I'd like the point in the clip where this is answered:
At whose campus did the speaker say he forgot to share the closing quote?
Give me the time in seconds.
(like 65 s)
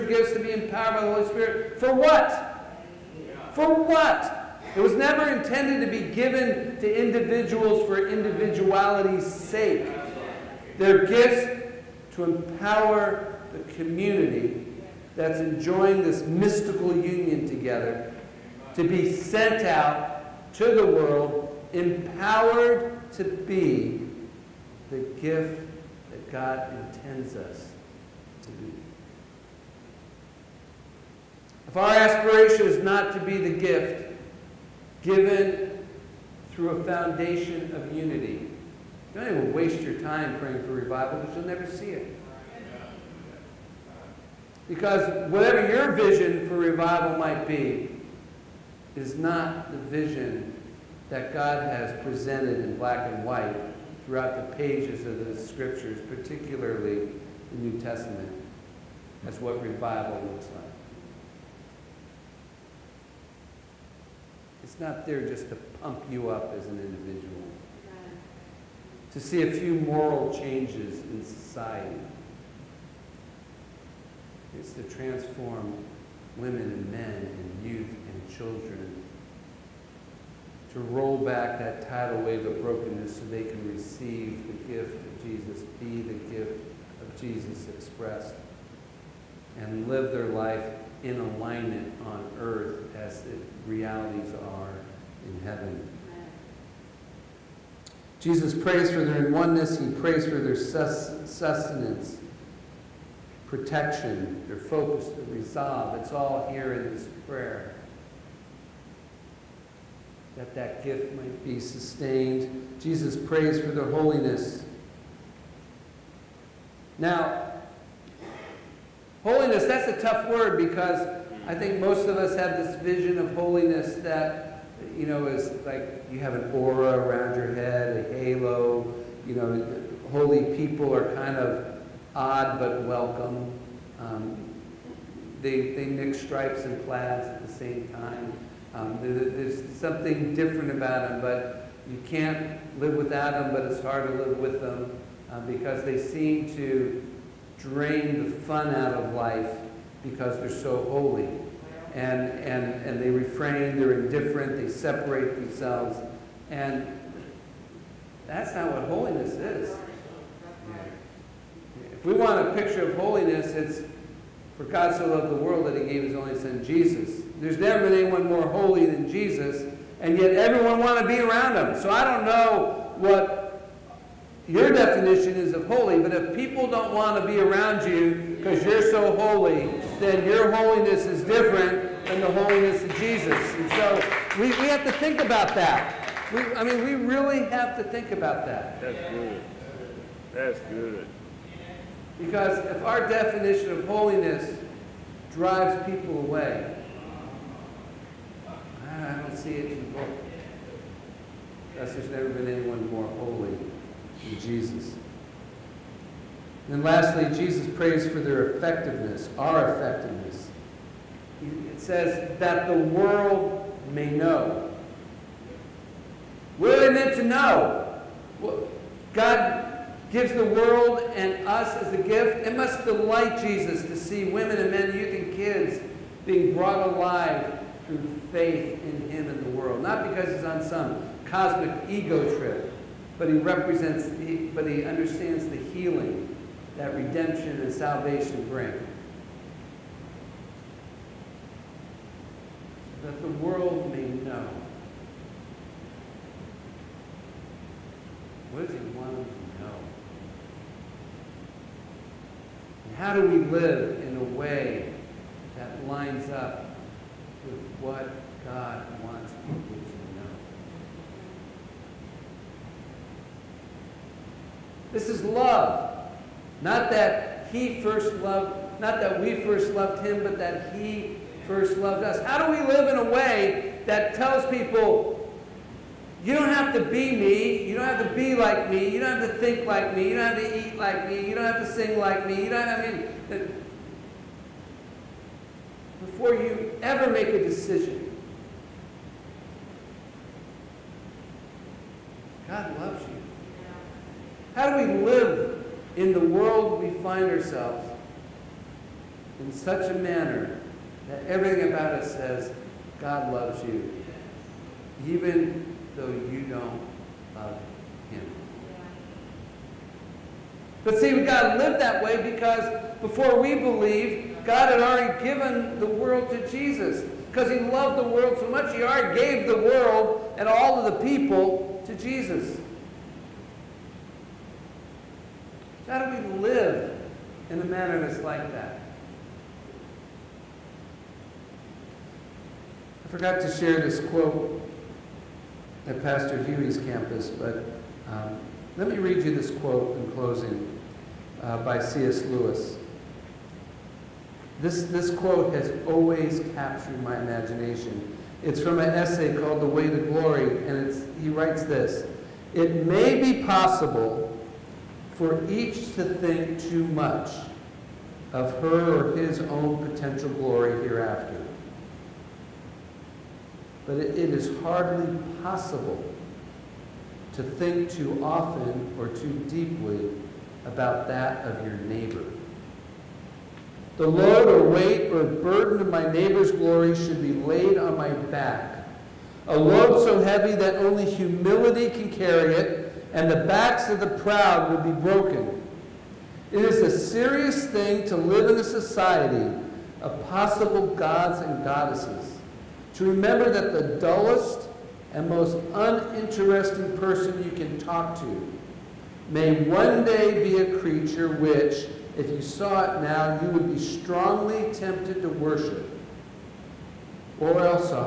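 336 s.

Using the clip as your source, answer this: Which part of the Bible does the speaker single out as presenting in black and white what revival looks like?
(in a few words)
the New Testament.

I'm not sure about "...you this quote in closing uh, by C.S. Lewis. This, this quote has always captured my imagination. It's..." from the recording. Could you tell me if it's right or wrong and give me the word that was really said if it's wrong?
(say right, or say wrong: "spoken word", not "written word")
right.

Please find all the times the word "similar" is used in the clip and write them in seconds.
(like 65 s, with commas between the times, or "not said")
not said.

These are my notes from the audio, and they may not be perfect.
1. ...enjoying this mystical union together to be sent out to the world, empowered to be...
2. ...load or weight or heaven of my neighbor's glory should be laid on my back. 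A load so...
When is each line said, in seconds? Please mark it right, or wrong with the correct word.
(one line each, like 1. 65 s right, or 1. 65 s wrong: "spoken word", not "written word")
1. 15 s right
2. 374 s wrong: "burden", not "heaven".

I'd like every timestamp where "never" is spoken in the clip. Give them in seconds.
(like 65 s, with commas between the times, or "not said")
4 s, 41 s, 167 s, 202 s.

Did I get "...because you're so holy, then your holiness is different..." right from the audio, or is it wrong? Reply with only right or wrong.
right.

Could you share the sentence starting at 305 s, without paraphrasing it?
Even though you don't love him.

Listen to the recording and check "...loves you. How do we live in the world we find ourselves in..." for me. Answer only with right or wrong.
right.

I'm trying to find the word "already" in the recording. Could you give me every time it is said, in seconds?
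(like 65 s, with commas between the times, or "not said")
314 s, 318 s.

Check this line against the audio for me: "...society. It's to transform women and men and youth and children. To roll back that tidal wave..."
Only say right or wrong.
right.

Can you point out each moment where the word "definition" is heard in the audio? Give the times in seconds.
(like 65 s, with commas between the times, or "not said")
174 s, 193 s.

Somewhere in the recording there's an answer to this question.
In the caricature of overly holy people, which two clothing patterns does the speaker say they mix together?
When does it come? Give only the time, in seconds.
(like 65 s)
136 s.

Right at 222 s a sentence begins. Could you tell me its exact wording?
It must delight Jesus to see women and men, youth and kids being brought alive through faith in him and the world.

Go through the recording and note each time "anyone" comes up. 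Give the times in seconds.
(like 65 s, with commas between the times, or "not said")
168 s, 202 s.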